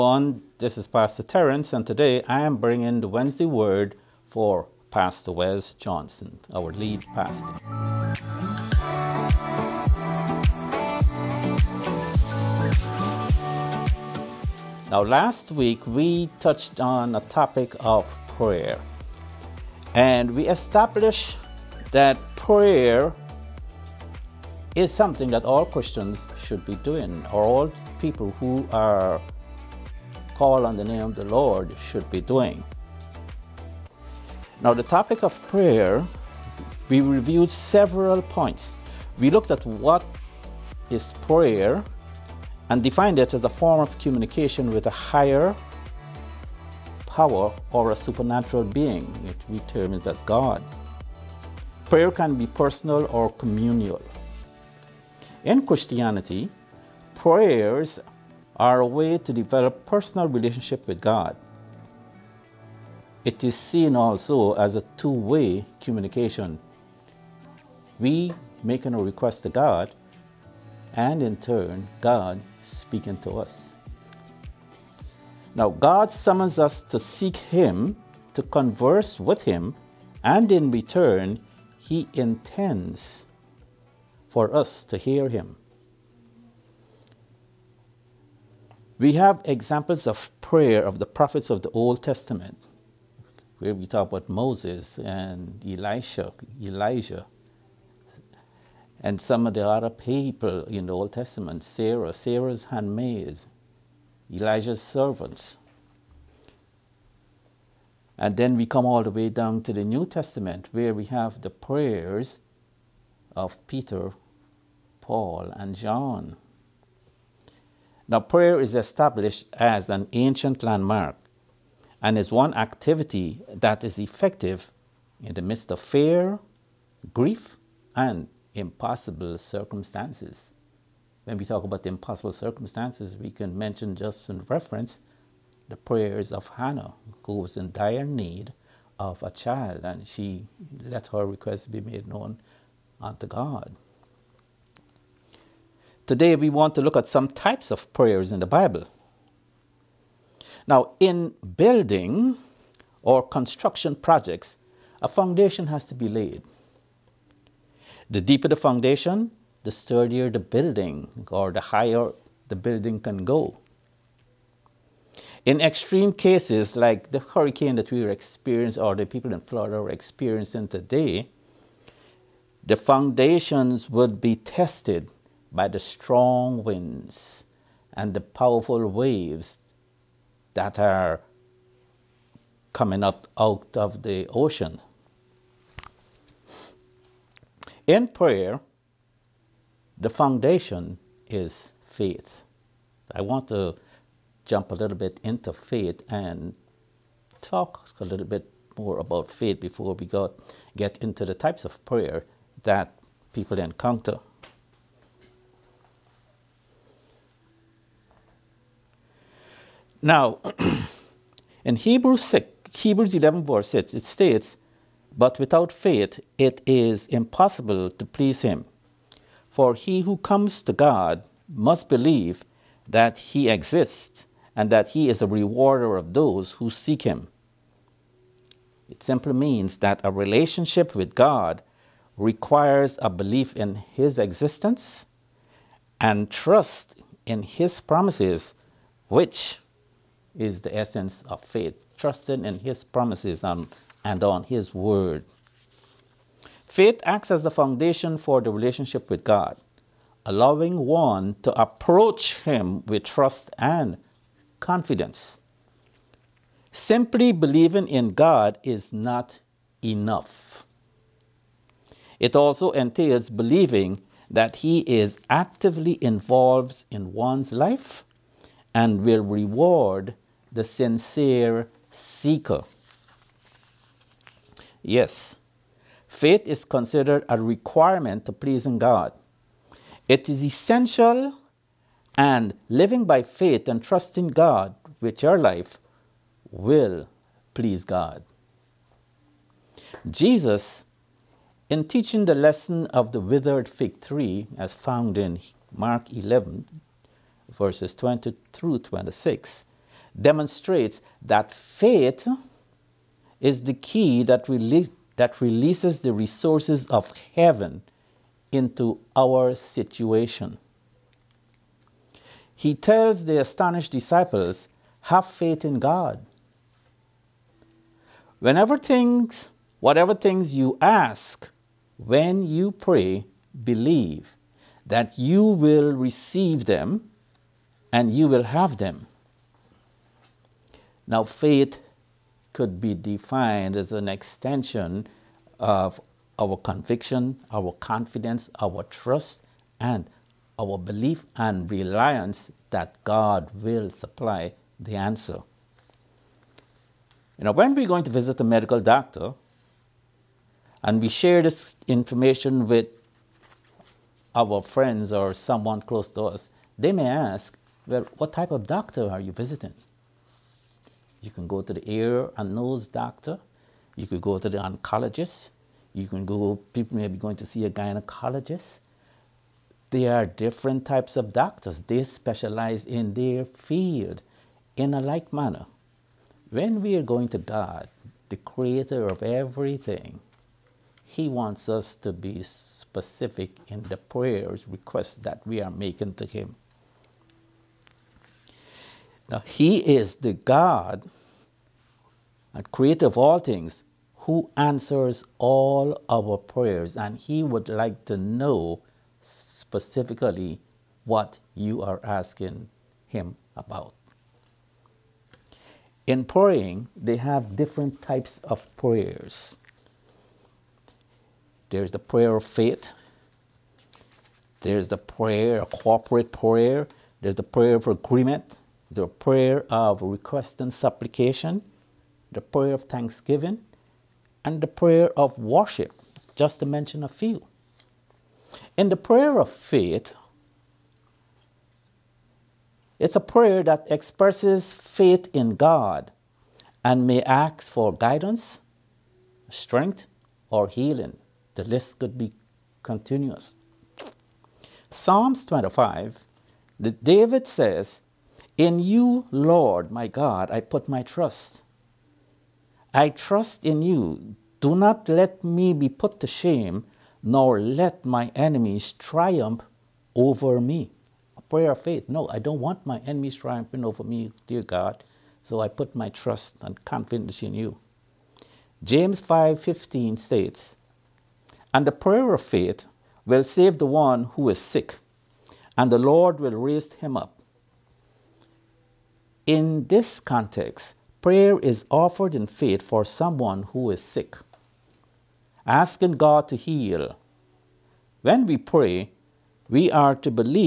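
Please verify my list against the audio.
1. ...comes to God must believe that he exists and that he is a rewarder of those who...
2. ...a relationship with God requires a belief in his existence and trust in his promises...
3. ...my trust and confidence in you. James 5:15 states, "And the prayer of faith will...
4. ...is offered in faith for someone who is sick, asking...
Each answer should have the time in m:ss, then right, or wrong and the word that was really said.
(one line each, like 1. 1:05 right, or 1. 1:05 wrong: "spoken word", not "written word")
1. 3:40 right
2. 3:50 right
3. 7:45 right
4. 8:01 right.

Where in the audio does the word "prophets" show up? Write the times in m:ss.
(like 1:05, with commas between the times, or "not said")
1:31.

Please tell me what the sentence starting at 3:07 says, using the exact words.
In prayer, the foundation is faith.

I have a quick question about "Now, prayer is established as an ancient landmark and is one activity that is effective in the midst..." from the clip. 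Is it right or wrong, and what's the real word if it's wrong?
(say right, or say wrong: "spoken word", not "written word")
right.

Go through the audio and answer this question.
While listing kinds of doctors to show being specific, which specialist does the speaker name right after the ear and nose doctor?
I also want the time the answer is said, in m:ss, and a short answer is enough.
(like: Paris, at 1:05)
Oncologist, at 6:04.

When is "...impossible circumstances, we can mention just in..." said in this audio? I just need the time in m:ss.
2:11.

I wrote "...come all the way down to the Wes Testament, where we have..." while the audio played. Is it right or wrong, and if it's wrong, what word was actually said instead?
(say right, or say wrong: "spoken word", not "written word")
wrong: "New", not "Wes".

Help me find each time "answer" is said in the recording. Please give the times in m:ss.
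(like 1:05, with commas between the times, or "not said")
5:44, 6:34.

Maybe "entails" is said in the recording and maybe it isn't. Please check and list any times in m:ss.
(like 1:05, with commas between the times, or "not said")
4:22.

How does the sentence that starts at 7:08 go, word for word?
In the prayer of faith, it's a prayer that expresses faith in God and may ask for guidance, strength, or healing.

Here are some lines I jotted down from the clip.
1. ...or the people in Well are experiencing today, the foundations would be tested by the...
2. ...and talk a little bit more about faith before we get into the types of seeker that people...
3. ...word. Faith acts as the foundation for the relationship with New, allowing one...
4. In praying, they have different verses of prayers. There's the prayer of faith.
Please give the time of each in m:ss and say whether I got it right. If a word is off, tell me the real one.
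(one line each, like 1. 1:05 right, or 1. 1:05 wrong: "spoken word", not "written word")
1. 2:48 wrong: "Florida", not "Well"
2. 3:16 wrong: "prayer", not "seeker"
3. 4:04 wrong: "God", not "New"
4. 6:46 wrong: "types", not "verses".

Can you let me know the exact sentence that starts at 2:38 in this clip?
The deeper the foundation, the sturdier the building or the higher the building can go.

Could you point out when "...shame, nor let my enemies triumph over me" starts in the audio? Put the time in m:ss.
7:36.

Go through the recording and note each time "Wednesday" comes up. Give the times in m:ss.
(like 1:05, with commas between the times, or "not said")
0:03.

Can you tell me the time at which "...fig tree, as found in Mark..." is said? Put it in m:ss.
4:53.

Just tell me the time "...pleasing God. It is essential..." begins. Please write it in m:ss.
4:38.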